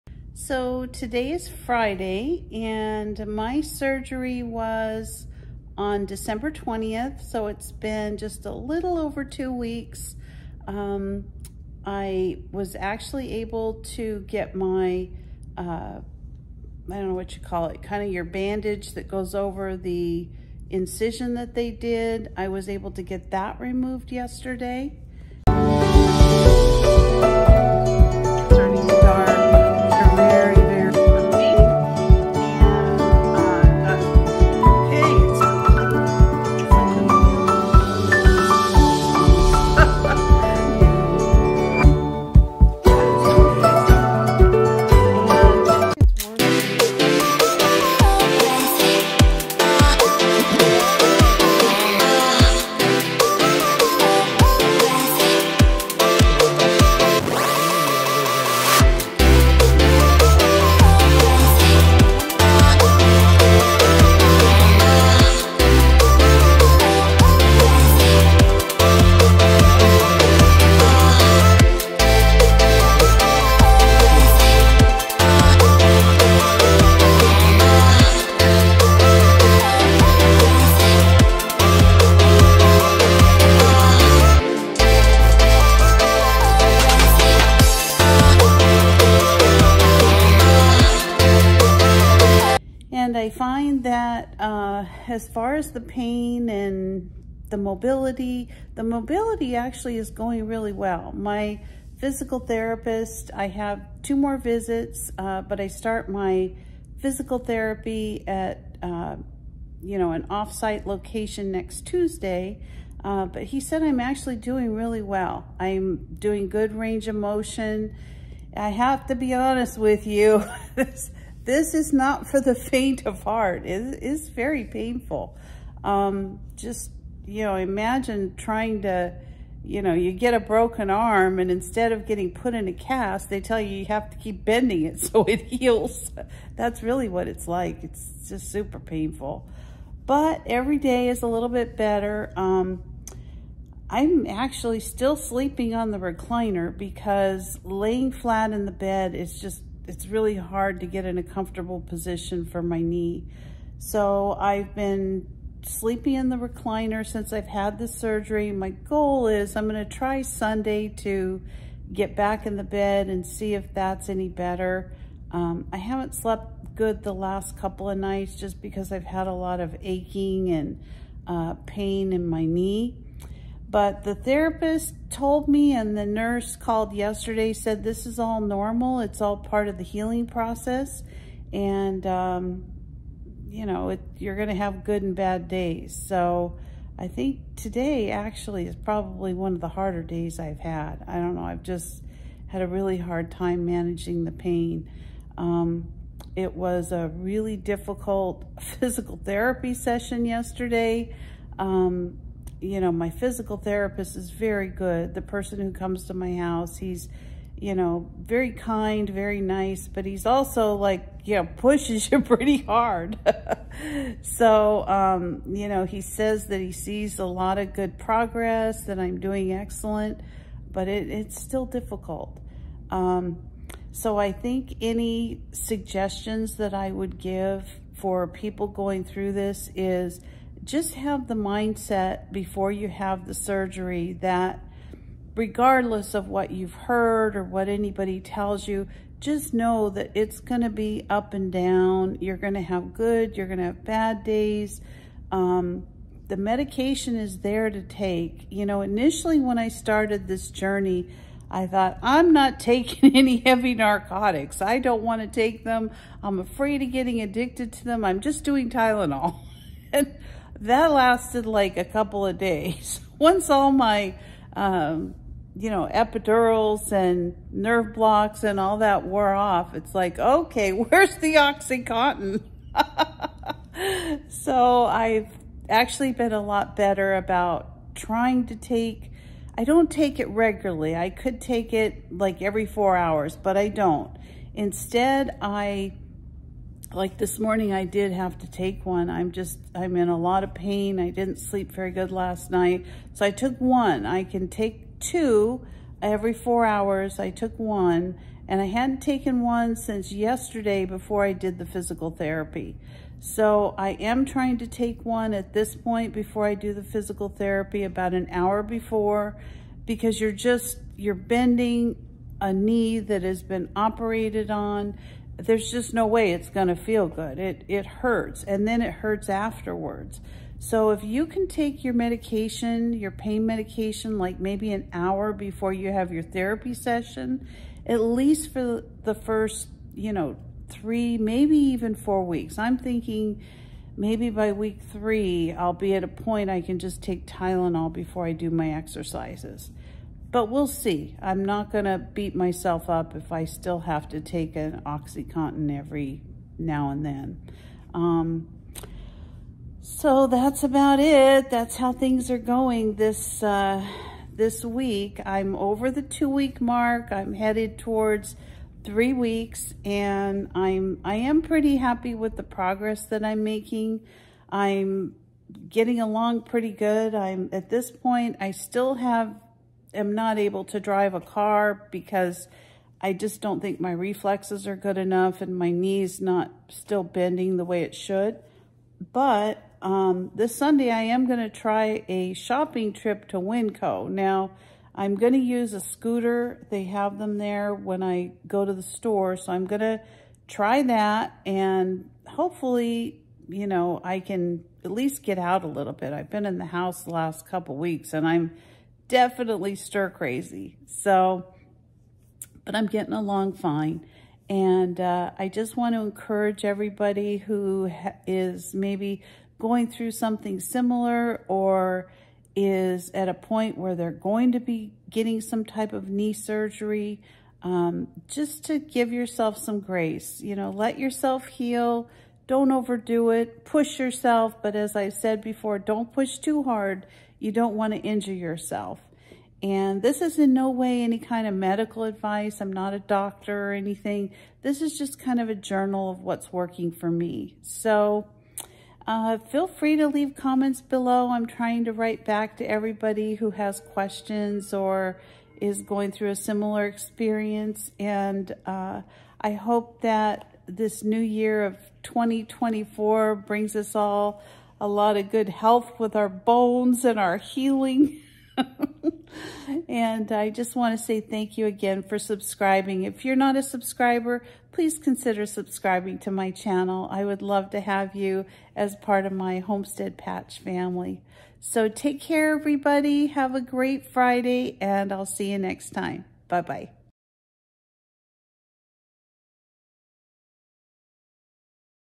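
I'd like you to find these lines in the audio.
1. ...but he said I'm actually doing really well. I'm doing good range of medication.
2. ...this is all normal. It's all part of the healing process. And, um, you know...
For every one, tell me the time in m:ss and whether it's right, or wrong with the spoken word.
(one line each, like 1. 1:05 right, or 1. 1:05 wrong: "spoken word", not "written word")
1. 1:53 wrong: "motion", not "medication"
2. 2:57 right.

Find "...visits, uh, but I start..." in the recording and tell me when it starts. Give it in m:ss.
1:44.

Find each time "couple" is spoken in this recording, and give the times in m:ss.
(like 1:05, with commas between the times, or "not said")
2:47, 4:21, 6:37.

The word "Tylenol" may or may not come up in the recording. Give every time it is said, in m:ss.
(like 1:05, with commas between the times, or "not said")
4:18, 5:37.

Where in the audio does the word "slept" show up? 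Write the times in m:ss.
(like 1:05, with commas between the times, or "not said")
2:46.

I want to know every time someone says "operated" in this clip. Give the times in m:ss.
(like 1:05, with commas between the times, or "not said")
5:13.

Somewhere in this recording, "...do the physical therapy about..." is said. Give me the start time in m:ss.
5:06.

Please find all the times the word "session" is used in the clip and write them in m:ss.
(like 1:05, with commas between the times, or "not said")
3:19, 5:26.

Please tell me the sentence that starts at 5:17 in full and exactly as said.
It, it hurts and then it hurts afterwards.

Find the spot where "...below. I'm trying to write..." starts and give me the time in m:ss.
7:20.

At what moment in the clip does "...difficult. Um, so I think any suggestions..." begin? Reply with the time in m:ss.
3:41.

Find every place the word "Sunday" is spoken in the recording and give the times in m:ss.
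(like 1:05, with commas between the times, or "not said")
2:40, 6:20.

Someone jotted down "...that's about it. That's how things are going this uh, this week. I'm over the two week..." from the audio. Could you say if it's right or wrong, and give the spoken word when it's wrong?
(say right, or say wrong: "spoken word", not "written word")
right.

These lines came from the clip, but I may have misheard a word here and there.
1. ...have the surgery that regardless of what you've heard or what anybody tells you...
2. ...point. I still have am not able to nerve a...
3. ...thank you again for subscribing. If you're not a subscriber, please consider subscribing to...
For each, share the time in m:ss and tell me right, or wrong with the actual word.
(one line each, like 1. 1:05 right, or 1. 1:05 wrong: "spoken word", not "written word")
1. 3:52 right
2. 6:07 wrong: "drive", not "nerve"
3. 7:41 right.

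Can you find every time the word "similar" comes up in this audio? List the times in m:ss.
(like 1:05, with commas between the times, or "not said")
6:50, 7:26.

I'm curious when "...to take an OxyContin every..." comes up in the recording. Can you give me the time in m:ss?
5:44.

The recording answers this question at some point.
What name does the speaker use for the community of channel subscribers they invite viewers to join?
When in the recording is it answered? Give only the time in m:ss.
7:49.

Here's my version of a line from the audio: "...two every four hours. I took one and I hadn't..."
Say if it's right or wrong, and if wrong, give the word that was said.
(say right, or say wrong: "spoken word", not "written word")
right.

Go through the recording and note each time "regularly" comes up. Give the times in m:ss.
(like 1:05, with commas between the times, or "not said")
4:40.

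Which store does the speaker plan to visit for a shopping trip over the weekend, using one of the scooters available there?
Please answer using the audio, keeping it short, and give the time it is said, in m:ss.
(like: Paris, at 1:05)
Winco, at 6:23.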